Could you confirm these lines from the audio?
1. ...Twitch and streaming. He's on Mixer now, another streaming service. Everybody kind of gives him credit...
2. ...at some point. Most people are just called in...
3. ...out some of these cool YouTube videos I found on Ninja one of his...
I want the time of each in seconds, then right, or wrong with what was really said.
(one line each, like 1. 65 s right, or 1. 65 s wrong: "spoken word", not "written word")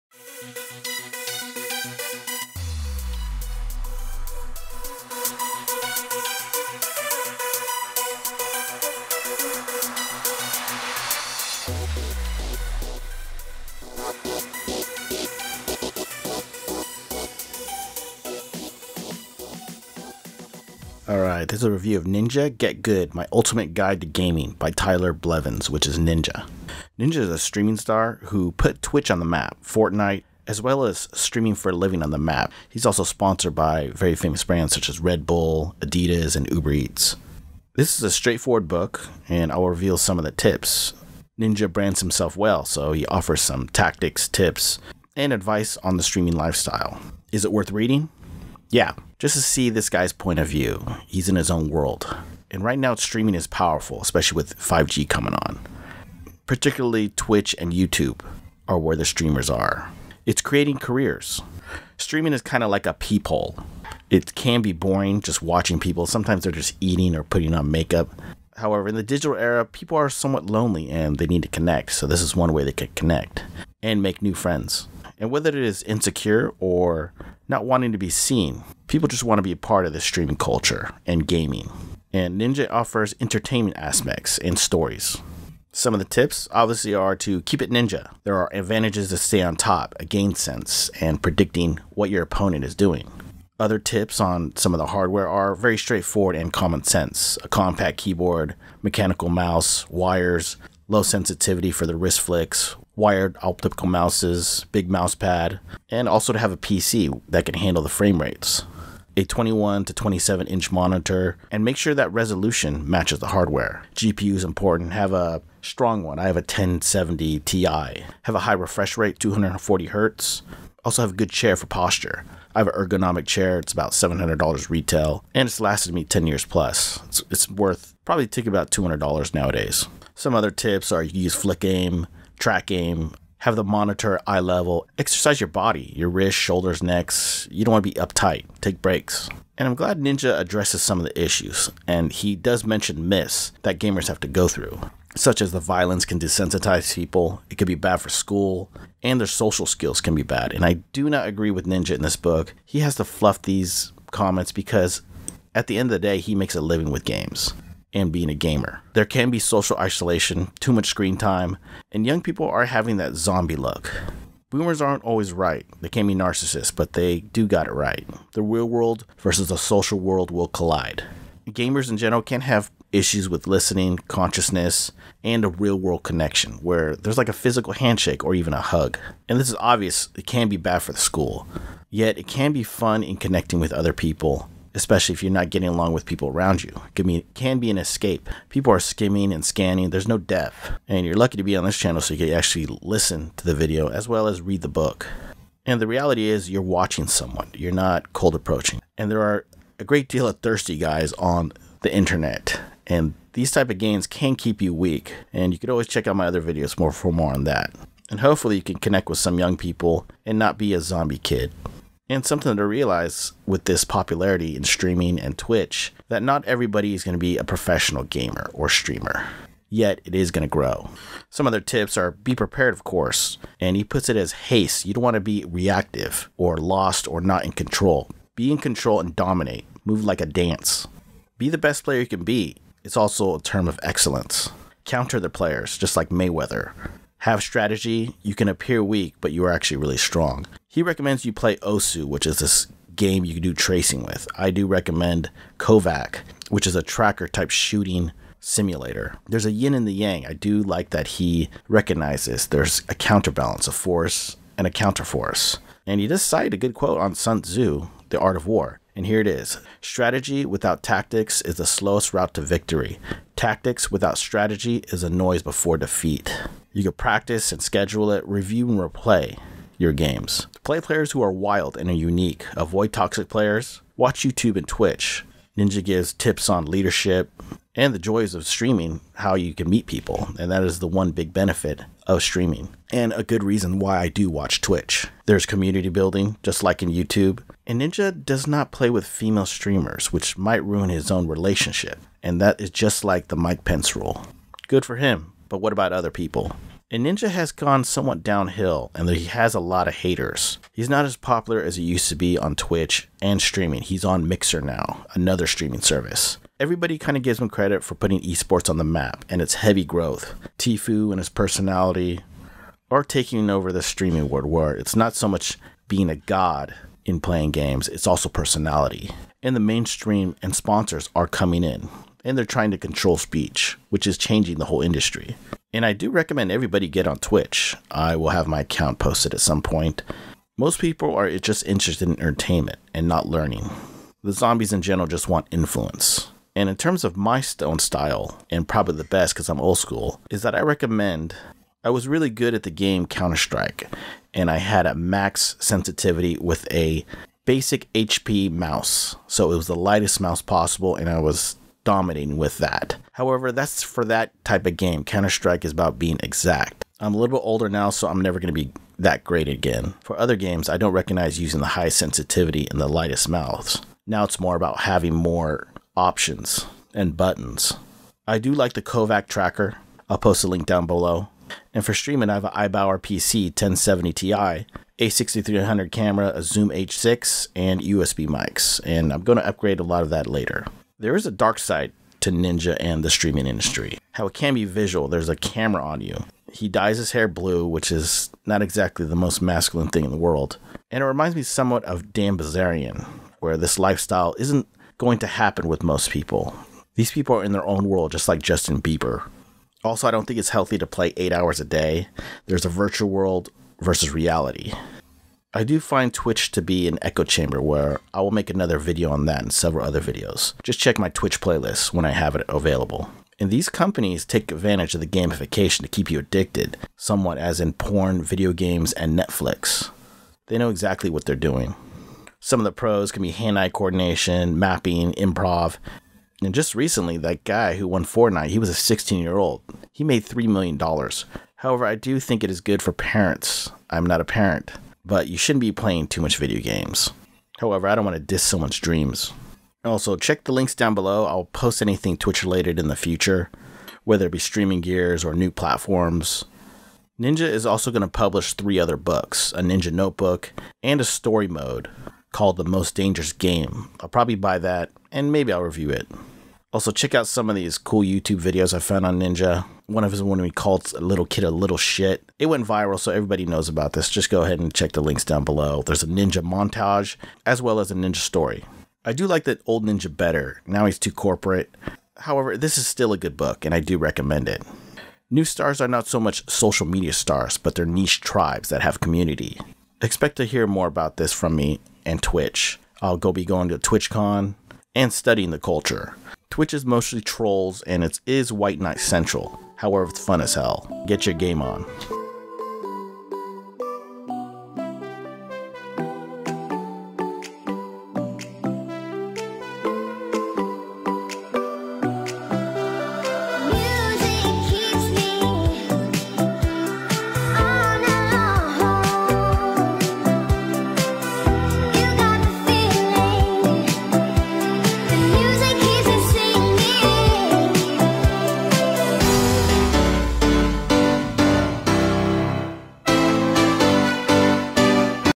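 1. 302 s right
2. 329 s wrong: "interested", not "called"
3. 457 s right.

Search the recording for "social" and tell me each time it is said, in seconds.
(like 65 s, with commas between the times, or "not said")
149 s, 159 s, 169 s, 476 s.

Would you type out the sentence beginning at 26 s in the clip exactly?
Ninja is a streaming star who put Twitch on the map, Fortnite, as well as streaming for a living on the map.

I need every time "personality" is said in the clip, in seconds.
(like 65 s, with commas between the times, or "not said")
311 s, 318 s.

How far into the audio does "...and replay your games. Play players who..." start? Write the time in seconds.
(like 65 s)
268 s.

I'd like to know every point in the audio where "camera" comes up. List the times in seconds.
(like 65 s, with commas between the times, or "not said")
375 s, 385 s.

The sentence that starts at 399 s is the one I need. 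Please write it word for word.
Also, I don't think it's healthy to play eight hours a day.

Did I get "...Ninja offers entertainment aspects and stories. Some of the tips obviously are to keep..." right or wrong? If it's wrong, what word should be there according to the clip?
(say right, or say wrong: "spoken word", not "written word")
right.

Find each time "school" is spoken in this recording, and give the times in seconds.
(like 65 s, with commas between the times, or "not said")
148 s, 180 s, 339 s.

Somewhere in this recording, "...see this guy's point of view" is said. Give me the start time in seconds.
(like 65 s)
49 s.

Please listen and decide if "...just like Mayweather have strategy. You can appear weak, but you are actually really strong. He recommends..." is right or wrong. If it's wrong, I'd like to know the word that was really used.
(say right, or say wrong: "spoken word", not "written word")
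right.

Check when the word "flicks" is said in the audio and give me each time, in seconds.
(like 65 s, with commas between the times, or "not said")
102 s, 131 s.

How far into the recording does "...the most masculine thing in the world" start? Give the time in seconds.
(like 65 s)
389 s.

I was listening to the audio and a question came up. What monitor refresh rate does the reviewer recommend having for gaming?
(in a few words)
240 hertz.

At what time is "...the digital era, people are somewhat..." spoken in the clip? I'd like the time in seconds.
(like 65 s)
68 s.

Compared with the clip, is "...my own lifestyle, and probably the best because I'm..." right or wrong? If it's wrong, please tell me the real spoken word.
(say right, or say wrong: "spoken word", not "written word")
wrong: "style", not "lifestyle".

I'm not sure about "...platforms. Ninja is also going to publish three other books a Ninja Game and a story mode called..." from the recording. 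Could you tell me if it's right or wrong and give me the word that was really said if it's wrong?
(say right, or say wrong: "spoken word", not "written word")
wrong: "Notebook", not "Game".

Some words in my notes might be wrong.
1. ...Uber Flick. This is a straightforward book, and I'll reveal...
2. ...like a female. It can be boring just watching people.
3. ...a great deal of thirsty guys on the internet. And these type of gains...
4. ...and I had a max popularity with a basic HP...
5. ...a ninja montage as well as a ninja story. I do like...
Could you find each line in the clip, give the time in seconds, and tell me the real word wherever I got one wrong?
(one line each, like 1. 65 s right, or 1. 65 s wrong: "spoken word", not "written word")
1. 36 s wrong: "Eats", not "Flick"
2. 62 s wrong: "peephole", not "female"
3. 199 s right
4. 344 s wrong: "sensitivity", not "popularity"
5. 466 s right.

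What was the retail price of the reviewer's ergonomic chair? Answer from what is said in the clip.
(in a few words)
$700.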